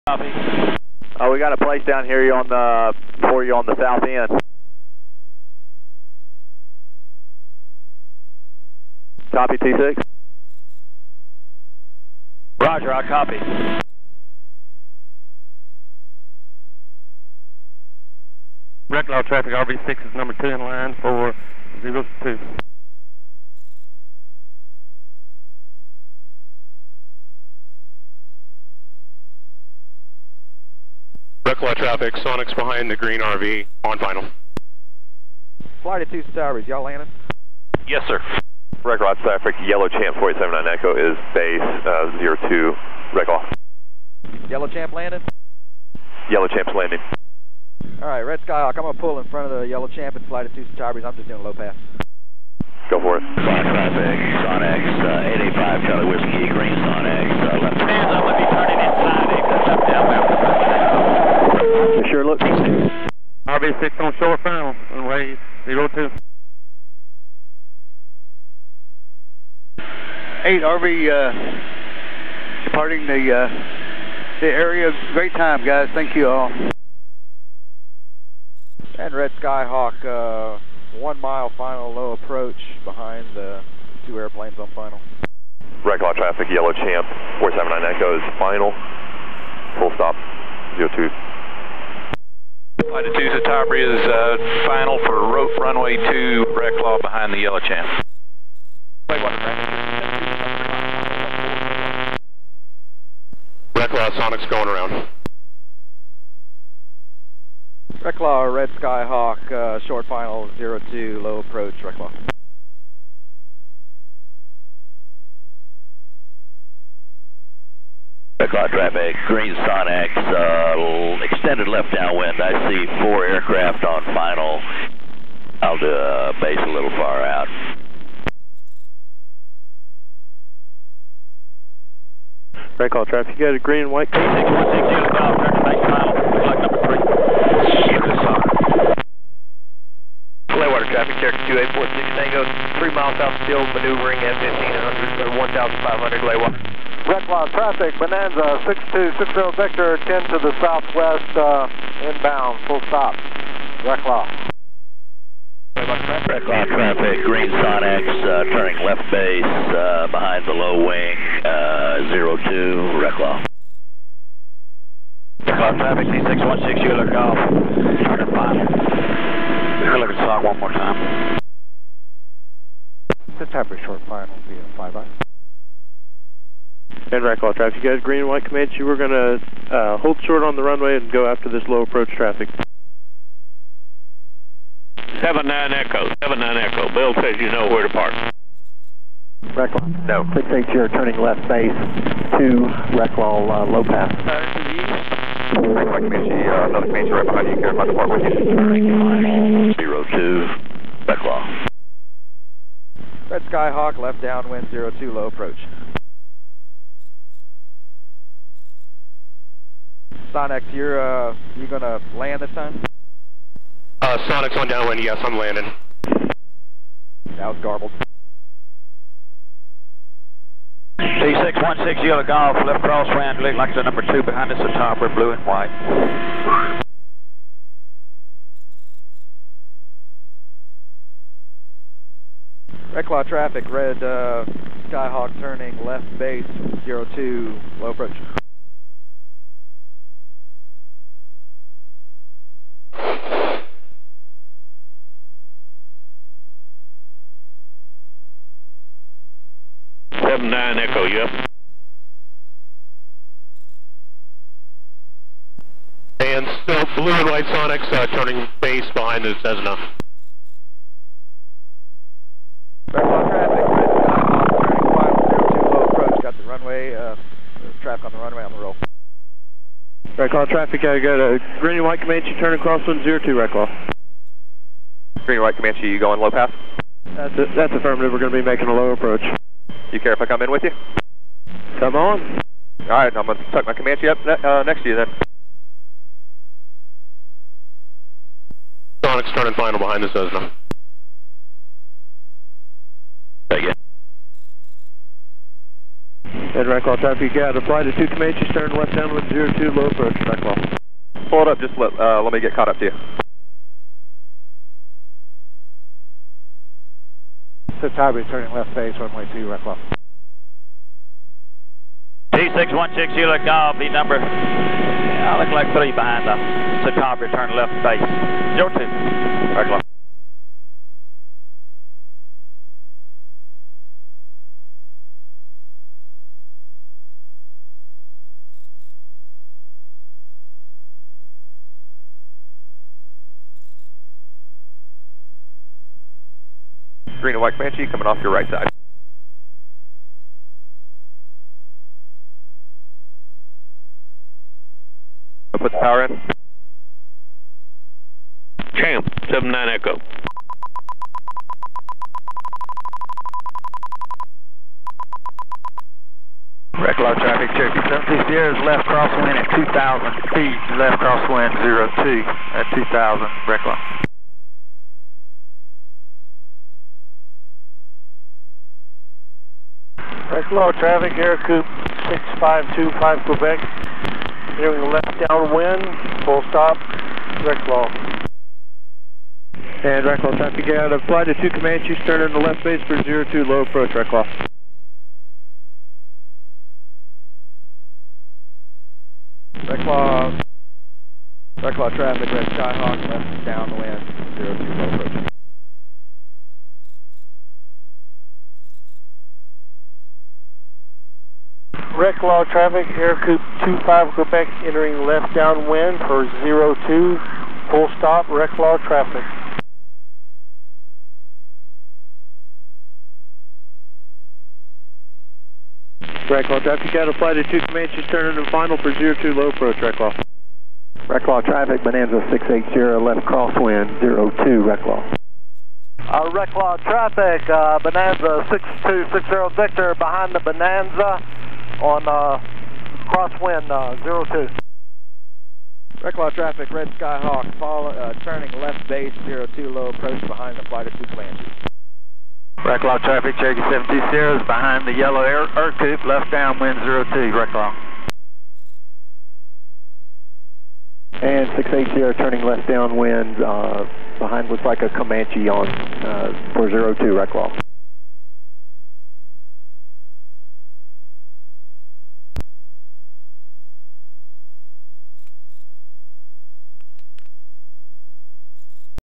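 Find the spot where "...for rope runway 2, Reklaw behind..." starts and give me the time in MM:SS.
01:35.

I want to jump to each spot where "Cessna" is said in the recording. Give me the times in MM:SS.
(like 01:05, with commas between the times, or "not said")
04:19, 04:50.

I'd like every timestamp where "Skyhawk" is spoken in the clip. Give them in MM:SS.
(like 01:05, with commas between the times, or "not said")
00:48, 01:19, 01:48, 03:23, 03:54, 06:32, 07:16.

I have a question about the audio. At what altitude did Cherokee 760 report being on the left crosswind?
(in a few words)
2,000 feet.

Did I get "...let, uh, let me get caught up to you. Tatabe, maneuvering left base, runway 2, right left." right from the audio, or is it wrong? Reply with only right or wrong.
wrong.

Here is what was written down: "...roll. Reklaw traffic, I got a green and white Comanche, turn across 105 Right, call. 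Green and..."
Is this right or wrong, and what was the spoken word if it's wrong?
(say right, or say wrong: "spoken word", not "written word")
wrong: "102", not "105".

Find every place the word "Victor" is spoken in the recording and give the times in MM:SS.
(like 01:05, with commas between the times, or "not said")
02:29, 07:09.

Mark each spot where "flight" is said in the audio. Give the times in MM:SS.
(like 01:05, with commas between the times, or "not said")
00:35, 01:32, 06:21, 06:57, 07:20.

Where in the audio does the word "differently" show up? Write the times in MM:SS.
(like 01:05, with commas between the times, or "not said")
not said.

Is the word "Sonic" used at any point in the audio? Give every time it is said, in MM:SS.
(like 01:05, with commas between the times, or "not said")
00:32, 01:44, 03:34, 04:49.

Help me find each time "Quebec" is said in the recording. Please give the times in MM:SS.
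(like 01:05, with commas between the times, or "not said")
06:13, 06:44.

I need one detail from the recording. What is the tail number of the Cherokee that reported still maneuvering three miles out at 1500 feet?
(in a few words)
2846 Tango.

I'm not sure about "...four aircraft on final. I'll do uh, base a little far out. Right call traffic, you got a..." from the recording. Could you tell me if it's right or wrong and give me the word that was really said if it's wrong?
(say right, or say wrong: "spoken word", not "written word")
right.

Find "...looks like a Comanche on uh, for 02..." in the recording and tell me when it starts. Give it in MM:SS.
07:34.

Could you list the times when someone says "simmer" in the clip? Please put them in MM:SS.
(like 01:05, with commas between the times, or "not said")
not said.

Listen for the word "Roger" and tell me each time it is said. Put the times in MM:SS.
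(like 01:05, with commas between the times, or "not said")
00:12.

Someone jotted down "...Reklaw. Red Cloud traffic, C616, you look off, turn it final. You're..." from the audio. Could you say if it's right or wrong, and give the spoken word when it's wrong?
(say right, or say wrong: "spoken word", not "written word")
right.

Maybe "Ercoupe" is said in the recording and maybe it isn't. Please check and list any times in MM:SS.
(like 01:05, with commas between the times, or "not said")
06:42, 07:25.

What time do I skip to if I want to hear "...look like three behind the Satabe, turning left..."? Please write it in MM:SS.
05:15.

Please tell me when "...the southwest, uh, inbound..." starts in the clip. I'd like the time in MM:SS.
02:30.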